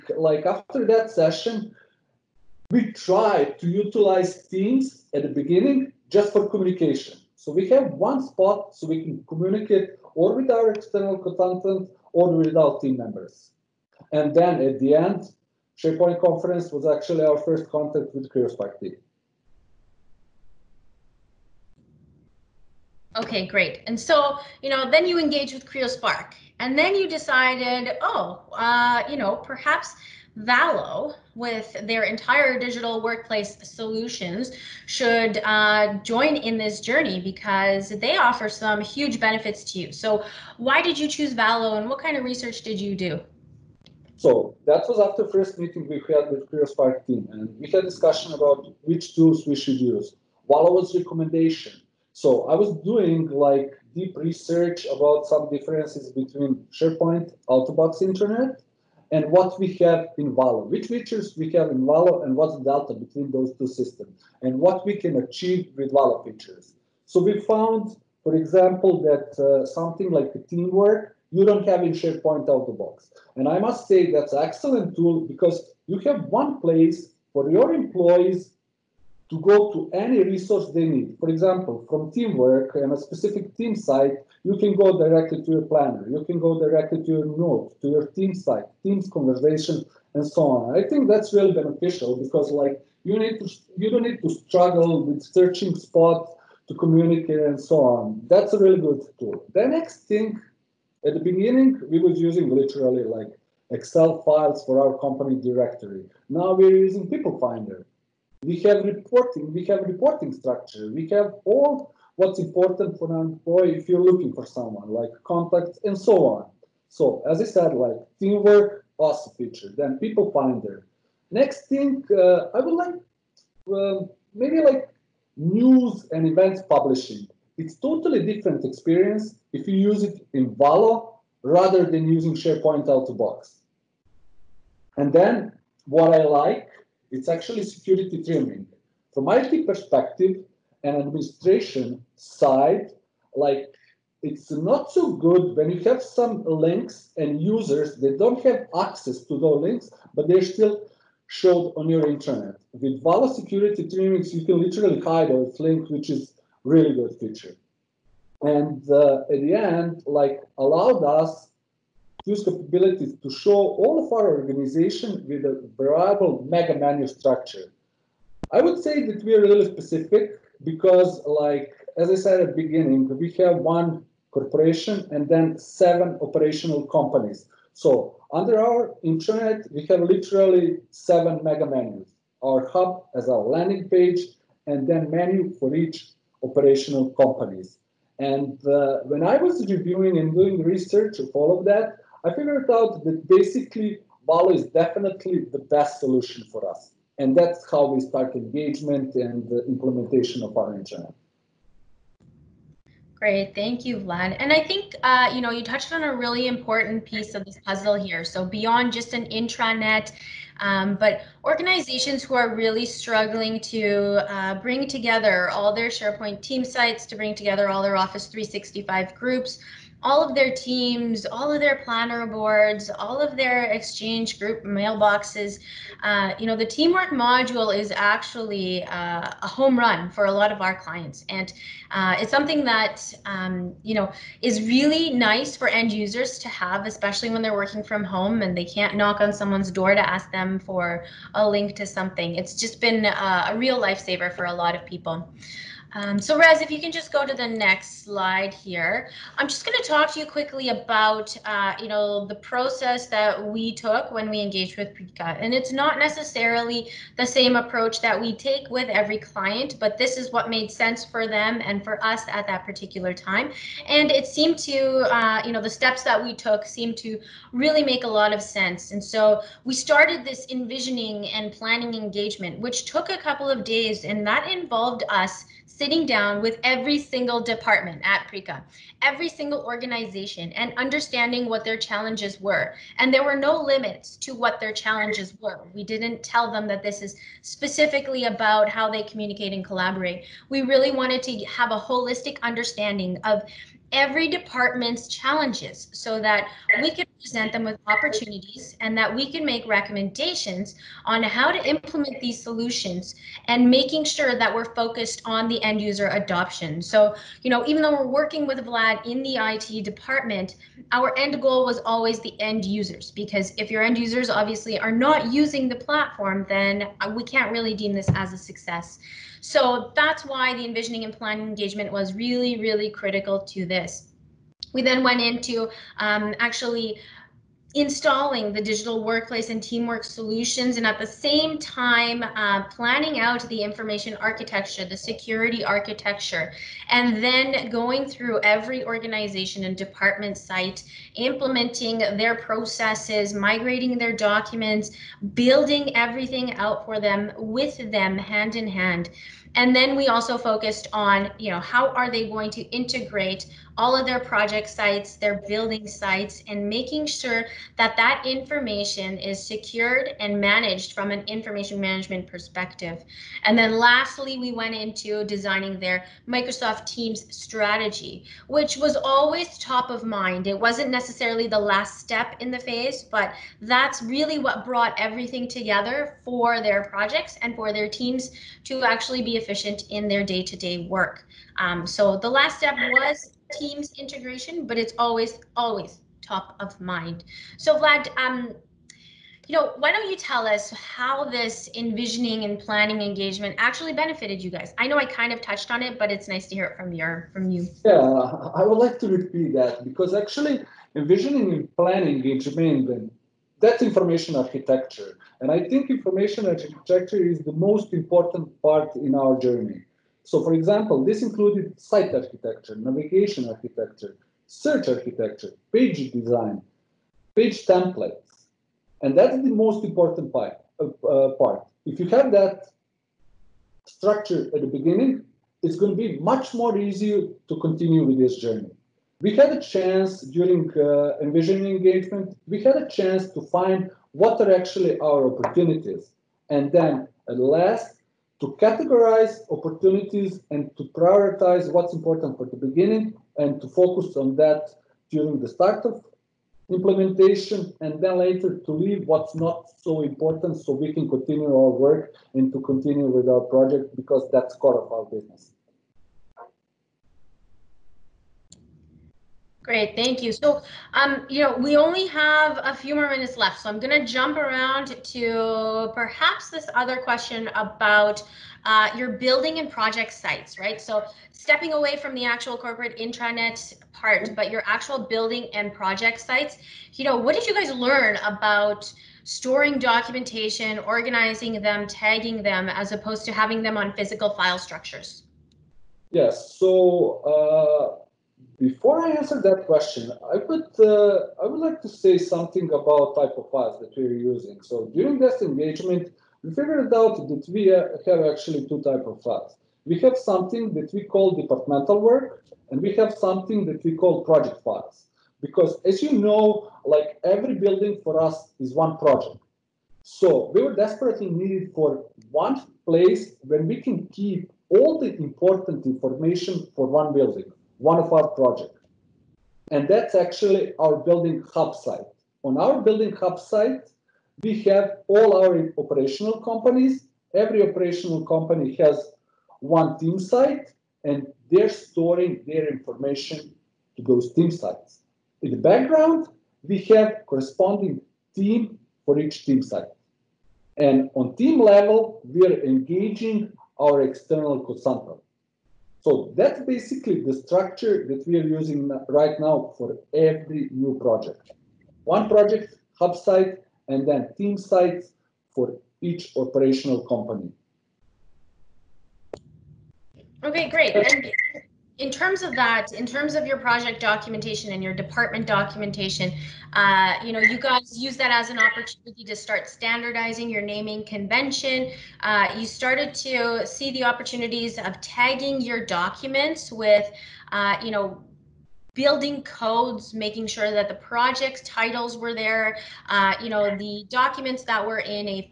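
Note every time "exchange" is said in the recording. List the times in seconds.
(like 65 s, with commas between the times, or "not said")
223 s.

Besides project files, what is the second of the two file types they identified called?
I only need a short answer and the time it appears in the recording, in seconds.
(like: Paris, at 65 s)
Departmental work, at 501 s.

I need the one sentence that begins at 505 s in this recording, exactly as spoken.
Because as you know, like every building for us is one project.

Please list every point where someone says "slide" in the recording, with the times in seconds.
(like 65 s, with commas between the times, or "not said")
248 s.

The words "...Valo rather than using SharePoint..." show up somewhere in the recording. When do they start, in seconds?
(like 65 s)
130 s.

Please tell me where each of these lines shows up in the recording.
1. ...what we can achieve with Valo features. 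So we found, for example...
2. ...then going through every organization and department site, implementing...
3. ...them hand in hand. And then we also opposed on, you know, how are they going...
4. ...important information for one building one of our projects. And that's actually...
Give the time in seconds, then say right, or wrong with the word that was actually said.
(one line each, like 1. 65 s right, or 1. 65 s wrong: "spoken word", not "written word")
1. 64 s right
2. 337 s right
3. 347 s wrong: "focused", not "opposed"
4. 515 s right.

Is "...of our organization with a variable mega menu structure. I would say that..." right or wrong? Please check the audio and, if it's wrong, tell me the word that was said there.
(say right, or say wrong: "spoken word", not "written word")
right.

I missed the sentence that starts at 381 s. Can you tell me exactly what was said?
Um, so the last step was Teams integration, but it's always, always top of mind.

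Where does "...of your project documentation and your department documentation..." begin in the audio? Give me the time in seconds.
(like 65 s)
563 s.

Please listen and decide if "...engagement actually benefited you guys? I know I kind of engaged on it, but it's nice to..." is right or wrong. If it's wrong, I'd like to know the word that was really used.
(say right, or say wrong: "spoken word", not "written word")
wrong: "touched", not "engaged".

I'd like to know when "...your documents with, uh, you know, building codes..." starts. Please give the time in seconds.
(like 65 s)
575 s.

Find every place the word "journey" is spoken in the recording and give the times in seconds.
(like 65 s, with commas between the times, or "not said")
36 s, 409 s, 428 s.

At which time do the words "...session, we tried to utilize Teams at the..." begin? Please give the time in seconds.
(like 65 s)
1 s.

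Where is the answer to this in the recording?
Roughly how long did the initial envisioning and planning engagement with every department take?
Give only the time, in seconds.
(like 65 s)
273 s.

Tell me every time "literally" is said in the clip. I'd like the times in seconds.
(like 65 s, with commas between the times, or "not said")
102 s, 154 s, 180 s.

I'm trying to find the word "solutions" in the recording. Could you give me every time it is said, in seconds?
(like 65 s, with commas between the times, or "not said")
33 s, 195 s, 302 s, 330 s.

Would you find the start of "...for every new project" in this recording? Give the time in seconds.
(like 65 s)
549 s.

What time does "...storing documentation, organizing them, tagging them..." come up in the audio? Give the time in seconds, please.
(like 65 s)
479 s.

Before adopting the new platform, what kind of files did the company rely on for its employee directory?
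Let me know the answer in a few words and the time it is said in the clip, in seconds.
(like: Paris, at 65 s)
Excel files, at 103 s.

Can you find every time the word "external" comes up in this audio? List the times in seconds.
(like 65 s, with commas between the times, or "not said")
10 s, 544 s.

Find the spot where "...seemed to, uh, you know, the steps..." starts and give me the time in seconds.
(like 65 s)
264 s.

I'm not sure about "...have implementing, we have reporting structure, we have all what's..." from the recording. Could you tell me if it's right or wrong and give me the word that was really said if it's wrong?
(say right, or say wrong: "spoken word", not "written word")
wrong: "reporting", not "implementing".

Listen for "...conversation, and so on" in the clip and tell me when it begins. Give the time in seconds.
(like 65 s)
89 s.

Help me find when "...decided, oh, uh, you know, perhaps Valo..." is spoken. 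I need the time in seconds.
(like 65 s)
27 s.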